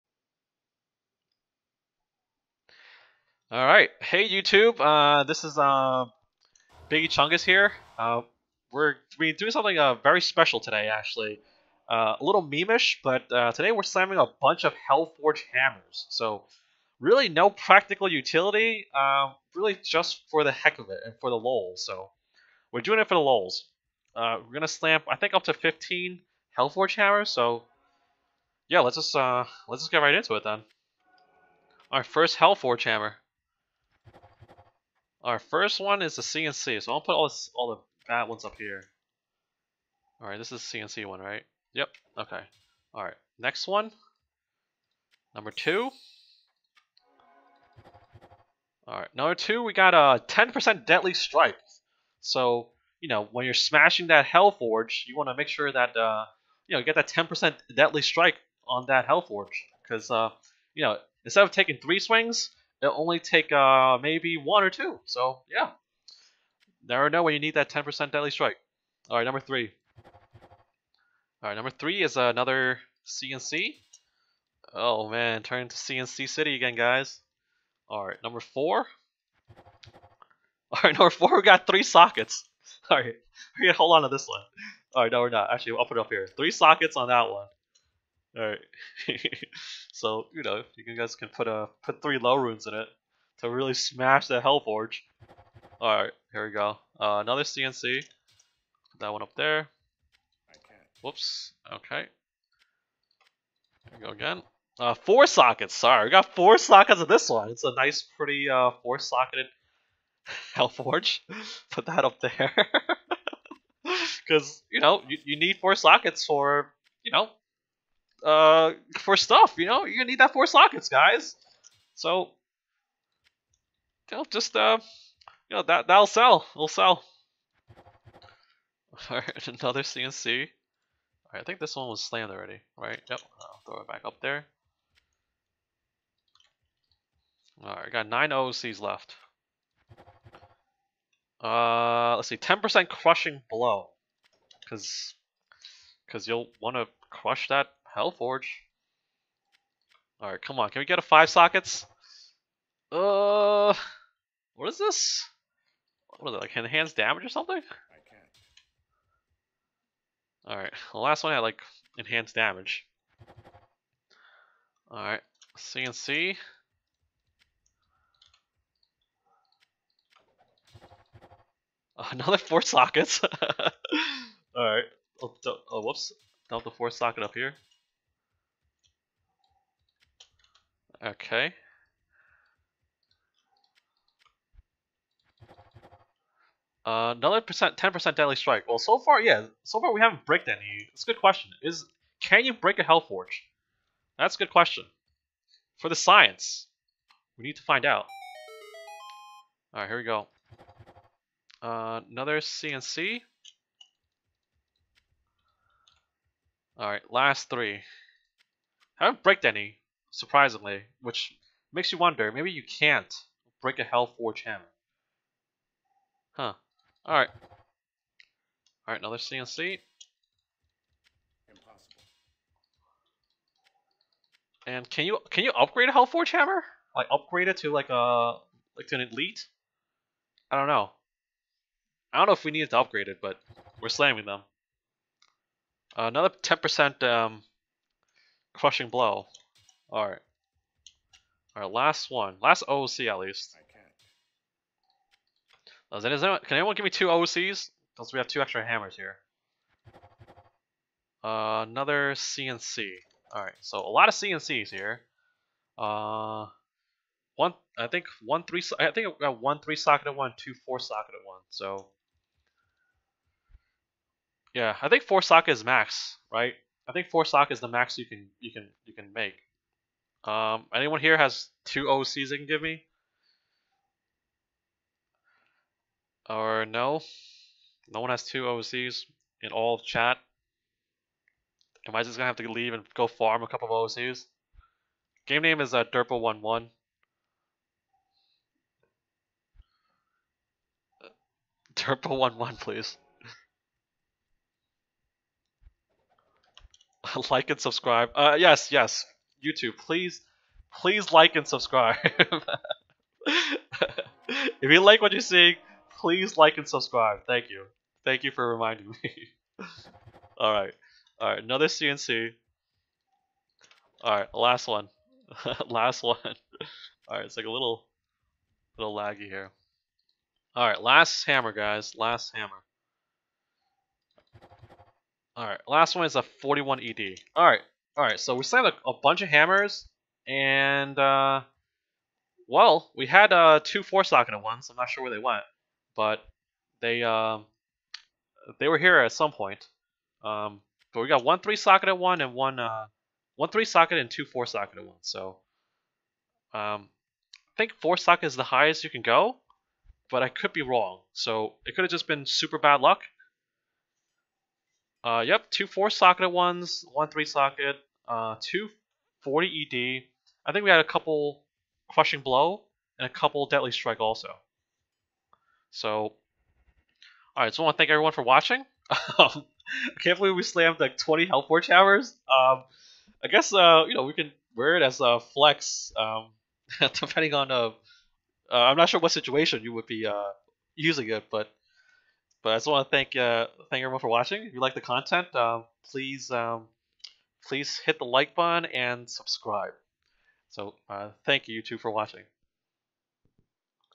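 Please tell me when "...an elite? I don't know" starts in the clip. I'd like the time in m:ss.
3:48.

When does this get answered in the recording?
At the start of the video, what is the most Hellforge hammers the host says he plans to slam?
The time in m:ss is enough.
0:25.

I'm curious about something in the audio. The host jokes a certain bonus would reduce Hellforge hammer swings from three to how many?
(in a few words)
one or two.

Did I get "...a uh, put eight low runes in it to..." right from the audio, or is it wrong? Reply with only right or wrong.
wrong.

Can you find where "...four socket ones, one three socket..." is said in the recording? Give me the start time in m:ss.
5:55.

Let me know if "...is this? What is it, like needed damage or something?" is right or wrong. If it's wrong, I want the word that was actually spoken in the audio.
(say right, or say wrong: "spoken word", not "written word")
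wrong: "enhanced", not "needed".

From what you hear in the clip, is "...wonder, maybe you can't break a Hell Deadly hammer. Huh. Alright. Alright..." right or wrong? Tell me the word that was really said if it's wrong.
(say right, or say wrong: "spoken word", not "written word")
wrong: "Forge", not "Deadly".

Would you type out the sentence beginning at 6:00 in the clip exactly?
I think we had a couple crushing blow and a couple deadly strike also.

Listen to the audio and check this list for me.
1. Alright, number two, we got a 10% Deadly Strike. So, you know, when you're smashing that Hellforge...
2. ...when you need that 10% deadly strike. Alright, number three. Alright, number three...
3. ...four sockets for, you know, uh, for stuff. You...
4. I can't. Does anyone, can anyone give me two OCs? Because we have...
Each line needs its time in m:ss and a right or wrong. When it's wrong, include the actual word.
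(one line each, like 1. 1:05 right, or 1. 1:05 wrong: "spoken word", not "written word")
1. 0:48 right
2. 1:07 right
3. 1:55 right
4. 4:03 right.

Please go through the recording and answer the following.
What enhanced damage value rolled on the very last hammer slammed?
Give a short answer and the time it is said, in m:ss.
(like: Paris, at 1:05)
41 ED, at 5:26.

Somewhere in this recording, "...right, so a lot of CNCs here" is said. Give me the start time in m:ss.
4:13.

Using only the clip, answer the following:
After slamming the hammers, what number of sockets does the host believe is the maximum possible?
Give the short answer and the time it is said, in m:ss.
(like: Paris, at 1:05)
4, at 4:25.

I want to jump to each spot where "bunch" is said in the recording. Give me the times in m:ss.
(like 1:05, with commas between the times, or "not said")
0:14, 5:29.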